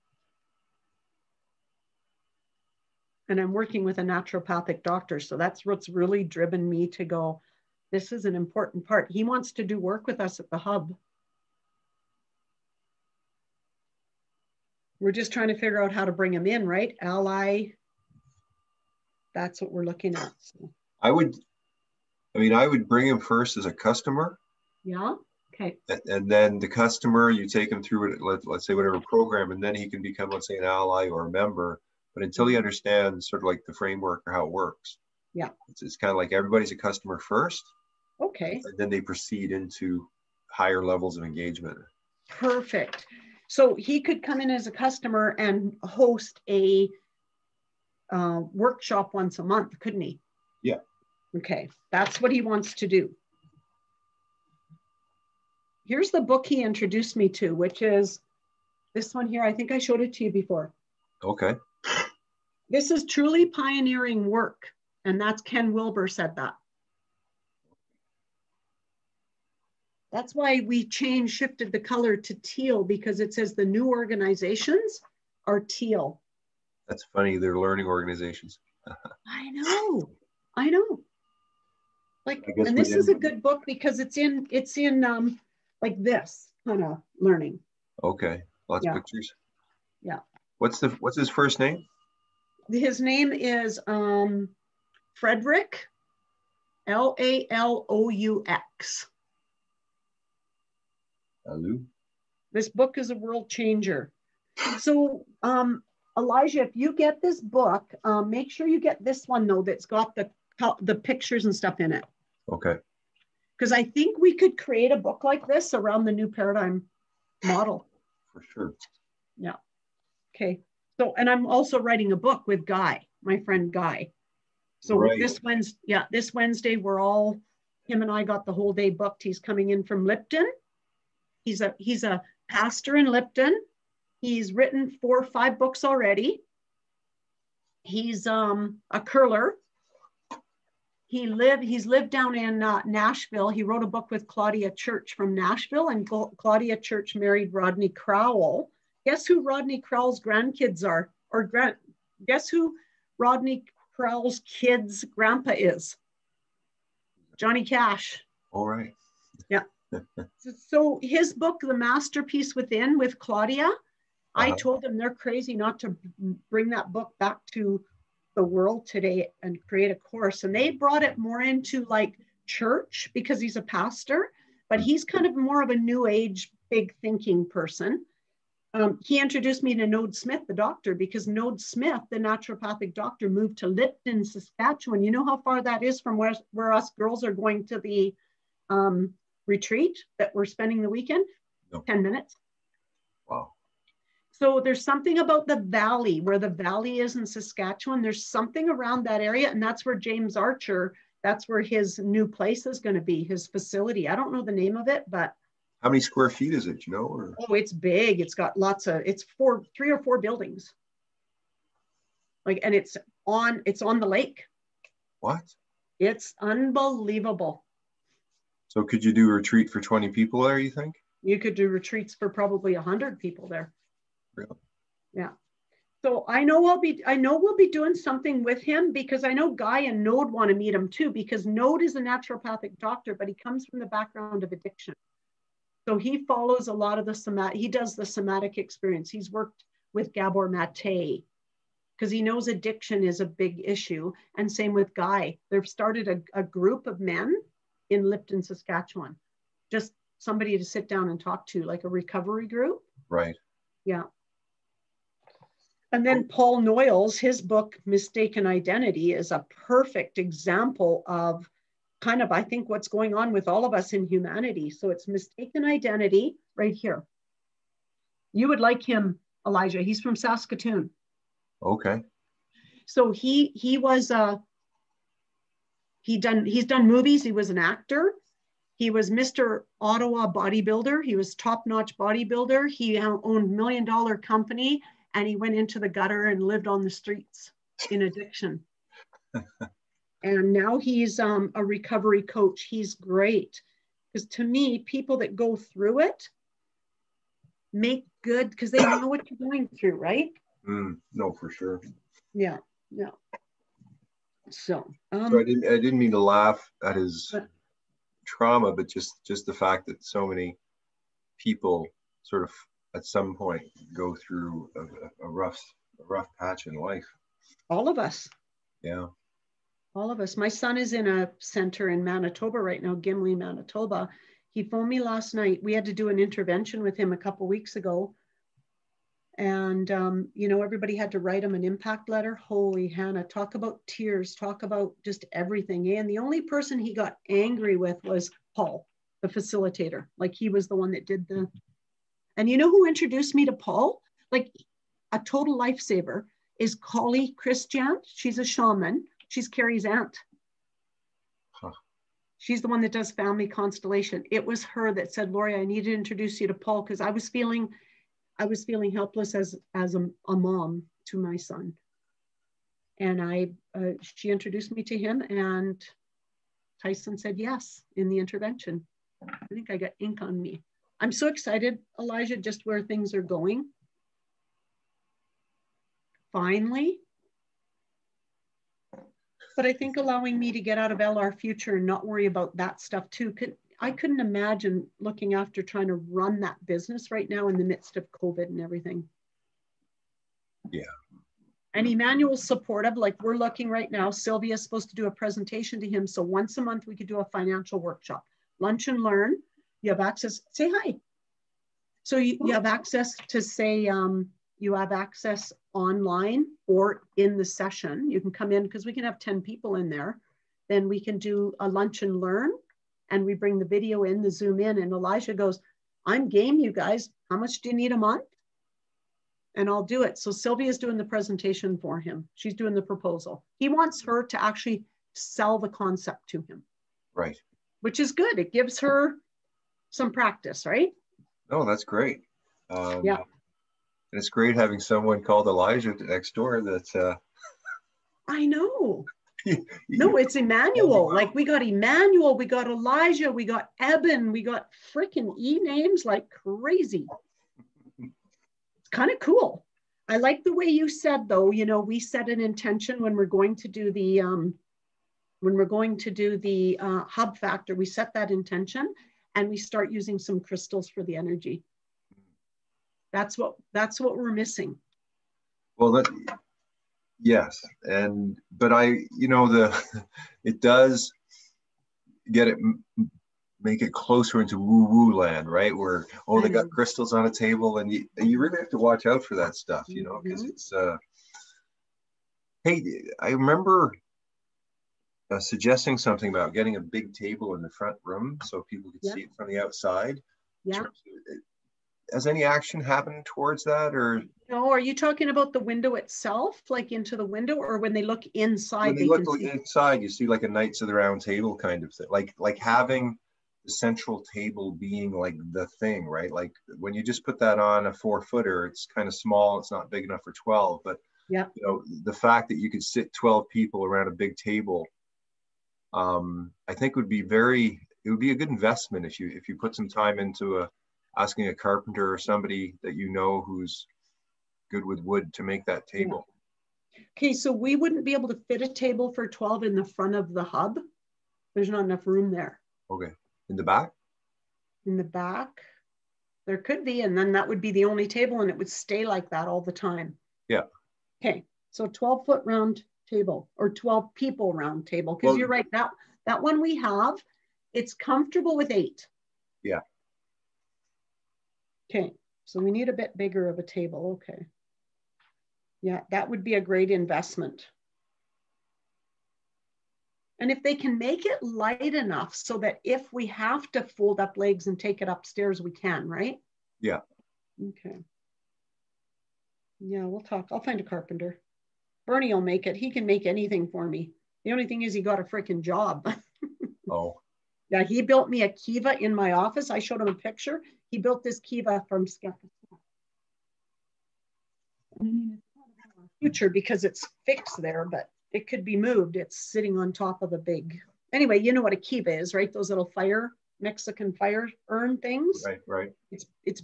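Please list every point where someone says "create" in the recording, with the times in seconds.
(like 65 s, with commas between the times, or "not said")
114 s, 169 s.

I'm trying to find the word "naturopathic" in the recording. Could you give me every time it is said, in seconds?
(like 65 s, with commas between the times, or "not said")
4 s, 182 s, 232 s.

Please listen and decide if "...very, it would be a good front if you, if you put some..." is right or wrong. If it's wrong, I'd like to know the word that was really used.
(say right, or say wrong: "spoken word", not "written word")
wrong: "investment", not "front".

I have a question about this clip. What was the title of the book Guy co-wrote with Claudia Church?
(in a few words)
The Masterpiece Within.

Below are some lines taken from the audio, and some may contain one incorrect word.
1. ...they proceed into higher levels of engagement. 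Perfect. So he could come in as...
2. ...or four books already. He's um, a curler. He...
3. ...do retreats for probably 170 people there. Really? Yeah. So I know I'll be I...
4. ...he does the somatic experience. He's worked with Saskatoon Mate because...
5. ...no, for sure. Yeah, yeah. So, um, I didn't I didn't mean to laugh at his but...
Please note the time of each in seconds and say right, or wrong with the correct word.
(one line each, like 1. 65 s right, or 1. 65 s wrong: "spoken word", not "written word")
1. 38 s right
2. 135 s wrong: "five", not "four"
3. 221 s wrong: "100", not "170"
4. 237 s wrong: "Gabor", not "Saskatoon"
5. 301 s right.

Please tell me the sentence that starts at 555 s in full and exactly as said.
Yeah, that would be a great investment.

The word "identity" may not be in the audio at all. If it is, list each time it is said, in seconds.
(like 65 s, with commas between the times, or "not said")
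258 s, 265 s.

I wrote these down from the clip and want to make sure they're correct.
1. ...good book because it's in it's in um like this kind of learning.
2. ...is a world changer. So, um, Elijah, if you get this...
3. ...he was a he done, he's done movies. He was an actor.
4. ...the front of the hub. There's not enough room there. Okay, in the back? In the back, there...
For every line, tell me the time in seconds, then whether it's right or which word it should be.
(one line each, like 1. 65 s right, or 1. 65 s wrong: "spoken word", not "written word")
1. 83 s right
2. 102 s right
3. 273 s right
4. 529 s right.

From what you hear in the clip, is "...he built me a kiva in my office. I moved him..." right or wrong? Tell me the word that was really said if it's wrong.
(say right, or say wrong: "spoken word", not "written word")
wrong: "showed", not "moved".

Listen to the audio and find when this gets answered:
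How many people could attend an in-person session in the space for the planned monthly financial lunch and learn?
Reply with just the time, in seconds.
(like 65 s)
409 s.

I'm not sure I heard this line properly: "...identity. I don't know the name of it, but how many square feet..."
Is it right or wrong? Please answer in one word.
wrong.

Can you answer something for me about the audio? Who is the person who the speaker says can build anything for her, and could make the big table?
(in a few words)
Bernie.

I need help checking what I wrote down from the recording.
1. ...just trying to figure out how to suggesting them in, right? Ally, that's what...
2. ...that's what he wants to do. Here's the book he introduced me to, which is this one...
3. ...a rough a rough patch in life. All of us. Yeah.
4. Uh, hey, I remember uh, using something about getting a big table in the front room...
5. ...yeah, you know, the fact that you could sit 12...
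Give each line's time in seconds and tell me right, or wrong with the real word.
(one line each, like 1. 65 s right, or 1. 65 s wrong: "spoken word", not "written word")
1. 15 s wrong: "bring", not "suggesting"
2. 51 s right
3. 315 s right
4. 480 s wrong: "suggesting", not "using"
5. 511 s right.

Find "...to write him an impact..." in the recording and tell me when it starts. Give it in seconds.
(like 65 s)
331 s.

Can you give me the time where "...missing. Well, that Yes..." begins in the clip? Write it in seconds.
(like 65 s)
464 s.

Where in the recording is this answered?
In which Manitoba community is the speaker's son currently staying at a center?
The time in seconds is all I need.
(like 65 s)
322 s.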